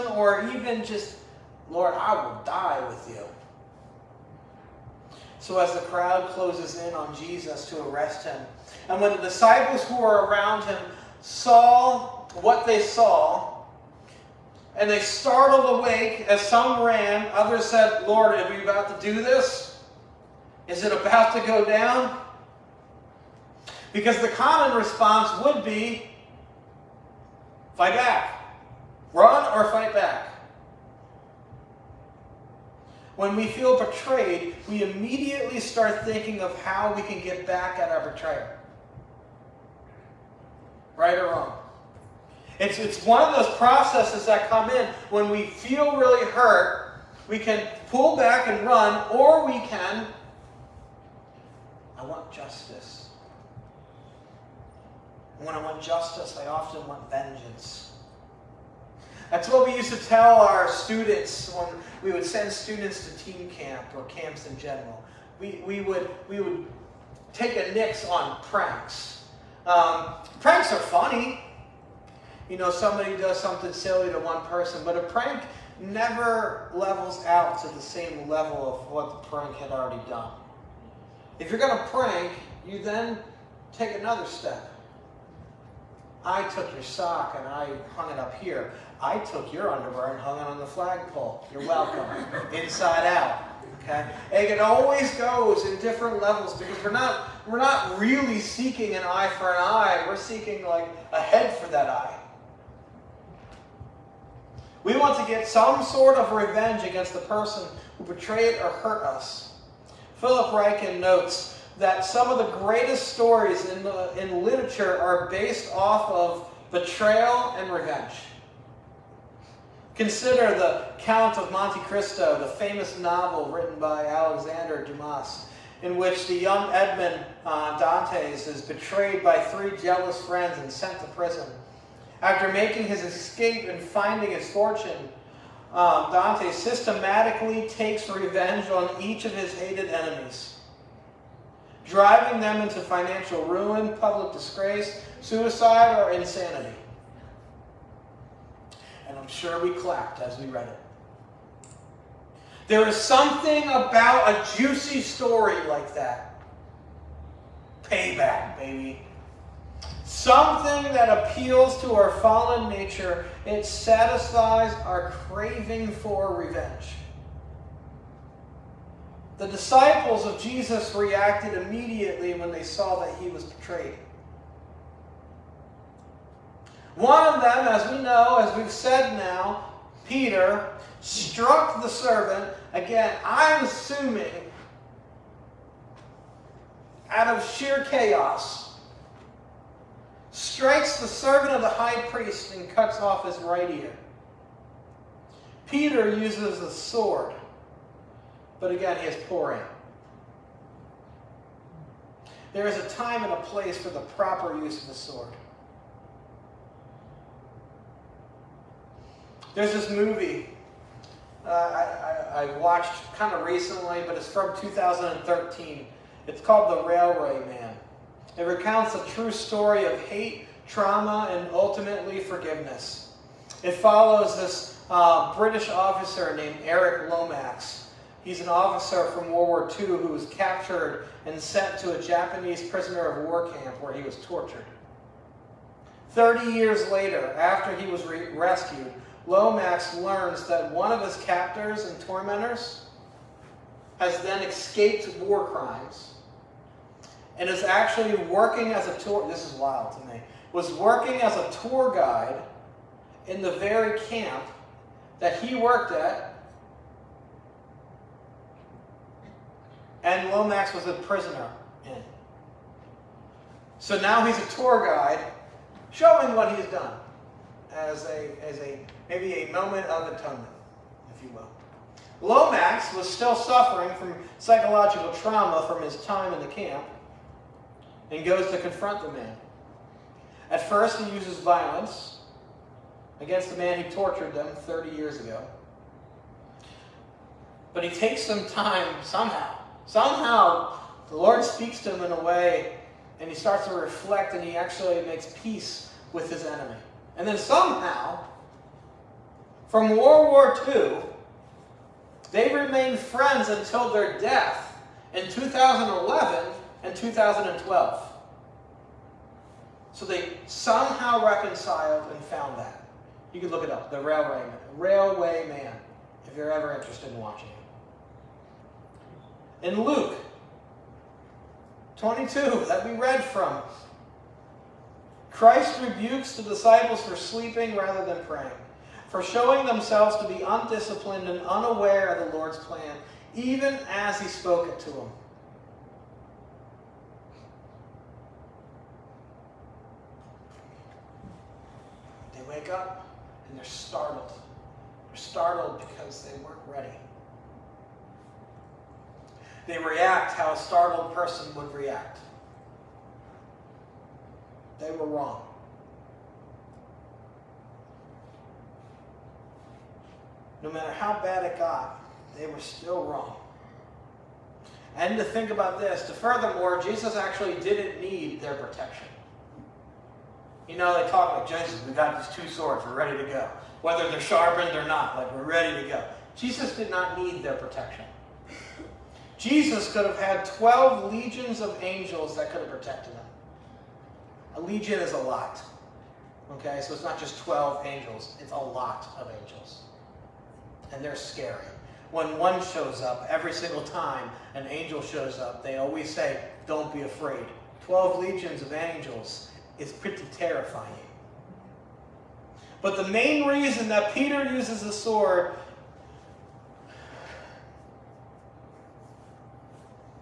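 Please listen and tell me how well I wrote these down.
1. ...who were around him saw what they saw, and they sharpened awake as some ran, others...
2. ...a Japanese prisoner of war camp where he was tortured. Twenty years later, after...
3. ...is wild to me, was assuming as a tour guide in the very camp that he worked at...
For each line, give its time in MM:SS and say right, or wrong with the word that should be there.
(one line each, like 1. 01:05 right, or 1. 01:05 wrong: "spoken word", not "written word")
1. 00:09 wrong: "startled", not "sharpened"
2. 03:51 wrong: "Thirty", not "Twenty"
3. 04:09 wrong: "working", not "assuming".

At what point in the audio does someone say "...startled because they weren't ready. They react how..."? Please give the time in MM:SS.
05:45.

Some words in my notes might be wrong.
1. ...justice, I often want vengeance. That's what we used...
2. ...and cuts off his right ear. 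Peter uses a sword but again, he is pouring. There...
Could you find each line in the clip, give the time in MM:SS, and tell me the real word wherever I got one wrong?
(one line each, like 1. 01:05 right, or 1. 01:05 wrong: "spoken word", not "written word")
1. 00:55 right
2. 03:12 right.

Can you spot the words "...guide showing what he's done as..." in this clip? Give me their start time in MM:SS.
04:24.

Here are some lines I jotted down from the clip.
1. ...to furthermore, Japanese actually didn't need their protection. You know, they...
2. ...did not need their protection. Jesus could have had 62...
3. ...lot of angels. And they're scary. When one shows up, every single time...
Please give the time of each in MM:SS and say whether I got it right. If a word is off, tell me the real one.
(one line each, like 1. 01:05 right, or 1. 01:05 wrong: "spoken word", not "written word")
1. 06:06 wrong: "Jesus", not "Japanese"
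2. 06:16 wrong: "12", not "62"
3. 06:28 right.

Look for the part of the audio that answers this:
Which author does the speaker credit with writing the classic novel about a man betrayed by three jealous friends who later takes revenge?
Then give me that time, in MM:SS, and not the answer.
02:04.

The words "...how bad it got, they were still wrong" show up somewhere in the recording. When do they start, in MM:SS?
06:00.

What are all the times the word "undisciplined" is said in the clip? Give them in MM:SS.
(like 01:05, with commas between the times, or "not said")
05:30.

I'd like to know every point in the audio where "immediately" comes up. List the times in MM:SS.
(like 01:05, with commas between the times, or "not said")
00:34, 02:51.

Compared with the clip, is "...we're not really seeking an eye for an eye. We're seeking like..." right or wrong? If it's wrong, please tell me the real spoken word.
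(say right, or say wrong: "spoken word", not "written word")
right.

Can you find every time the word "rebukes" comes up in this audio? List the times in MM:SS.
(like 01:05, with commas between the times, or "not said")
05:25.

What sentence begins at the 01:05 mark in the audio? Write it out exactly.
We, we, would, we would take a nix on pranks.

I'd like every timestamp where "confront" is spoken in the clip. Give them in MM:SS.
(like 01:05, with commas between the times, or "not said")
04:38.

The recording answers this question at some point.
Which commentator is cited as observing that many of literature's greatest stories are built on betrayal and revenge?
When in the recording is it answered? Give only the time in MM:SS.
01:50.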